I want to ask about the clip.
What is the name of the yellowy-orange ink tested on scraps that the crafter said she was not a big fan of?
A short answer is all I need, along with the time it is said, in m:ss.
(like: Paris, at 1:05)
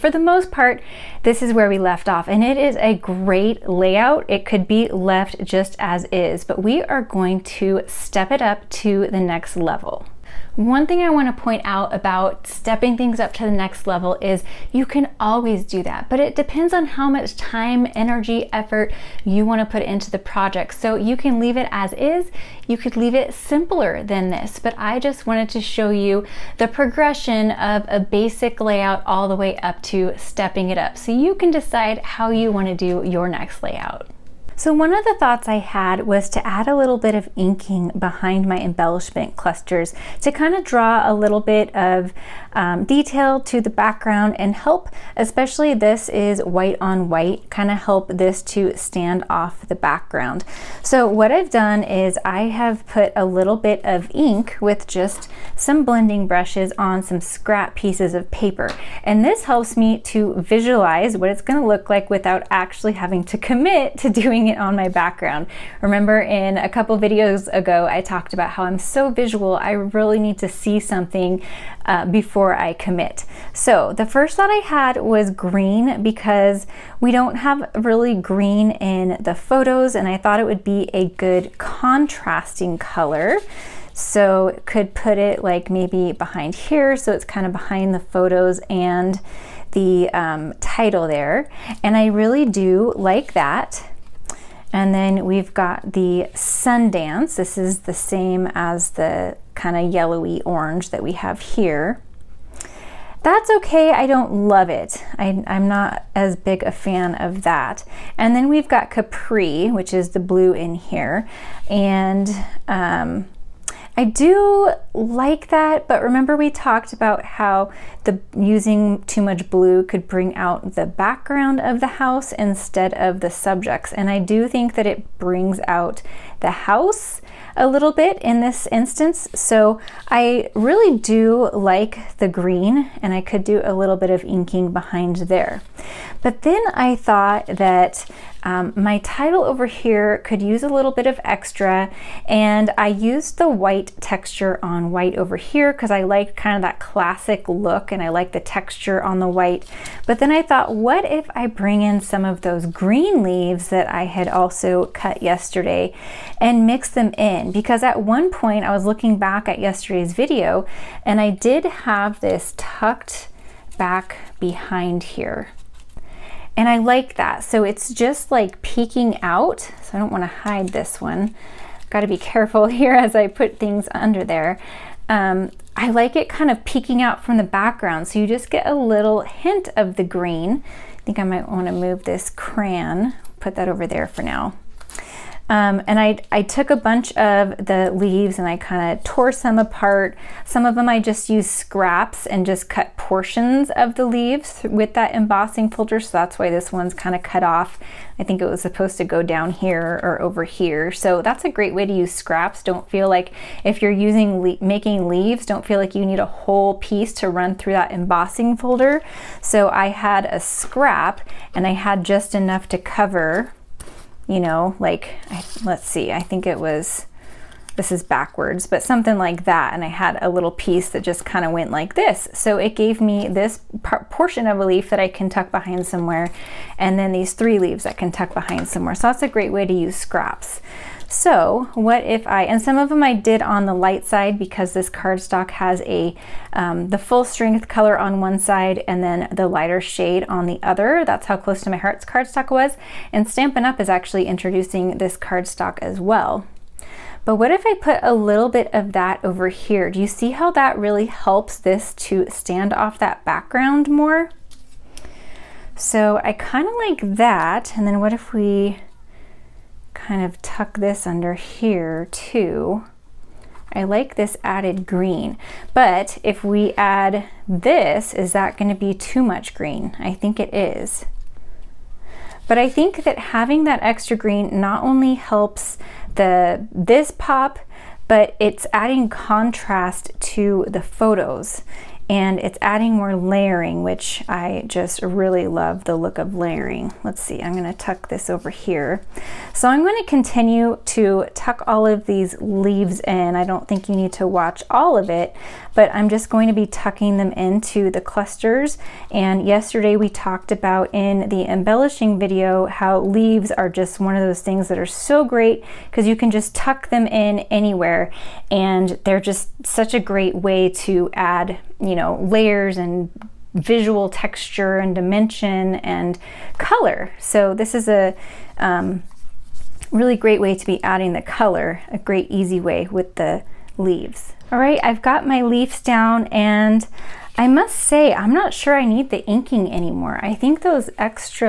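Sundance, at 1:36.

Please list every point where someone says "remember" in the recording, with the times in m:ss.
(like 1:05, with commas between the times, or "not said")
1:05, 1:56.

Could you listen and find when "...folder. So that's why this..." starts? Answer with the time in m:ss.
3:15.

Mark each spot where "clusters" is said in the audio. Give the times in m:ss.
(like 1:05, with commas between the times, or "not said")
0:39, 4:58.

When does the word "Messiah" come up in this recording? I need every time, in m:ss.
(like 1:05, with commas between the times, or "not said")
not said.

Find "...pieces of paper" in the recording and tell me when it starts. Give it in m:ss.
0:57.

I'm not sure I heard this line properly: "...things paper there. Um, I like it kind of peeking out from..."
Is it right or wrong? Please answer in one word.
wrong.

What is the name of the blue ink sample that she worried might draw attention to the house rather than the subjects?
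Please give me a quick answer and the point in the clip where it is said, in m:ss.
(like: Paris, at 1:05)
Capri, at 1:48.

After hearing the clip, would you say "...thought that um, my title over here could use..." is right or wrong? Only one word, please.
right.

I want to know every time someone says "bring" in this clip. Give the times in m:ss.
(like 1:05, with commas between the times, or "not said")
2:00, 2:05, 2:31.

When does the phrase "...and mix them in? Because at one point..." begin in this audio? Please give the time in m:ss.
2:36.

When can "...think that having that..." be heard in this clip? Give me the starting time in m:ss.
4:32.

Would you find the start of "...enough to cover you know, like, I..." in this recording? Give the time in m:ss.
3:32.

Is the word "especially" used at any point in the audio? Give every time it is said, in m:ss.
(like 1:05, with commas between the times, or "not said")
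0:45.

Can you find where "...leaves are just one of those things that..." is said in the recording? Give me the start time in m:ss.
5:02.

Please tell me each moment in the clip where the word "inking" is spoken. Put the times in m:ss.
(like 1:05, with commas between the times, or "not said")
0:37, 2:14, 5:29.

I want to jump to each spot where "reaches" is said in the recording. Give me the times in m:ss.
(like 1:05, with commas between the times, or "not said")
not said.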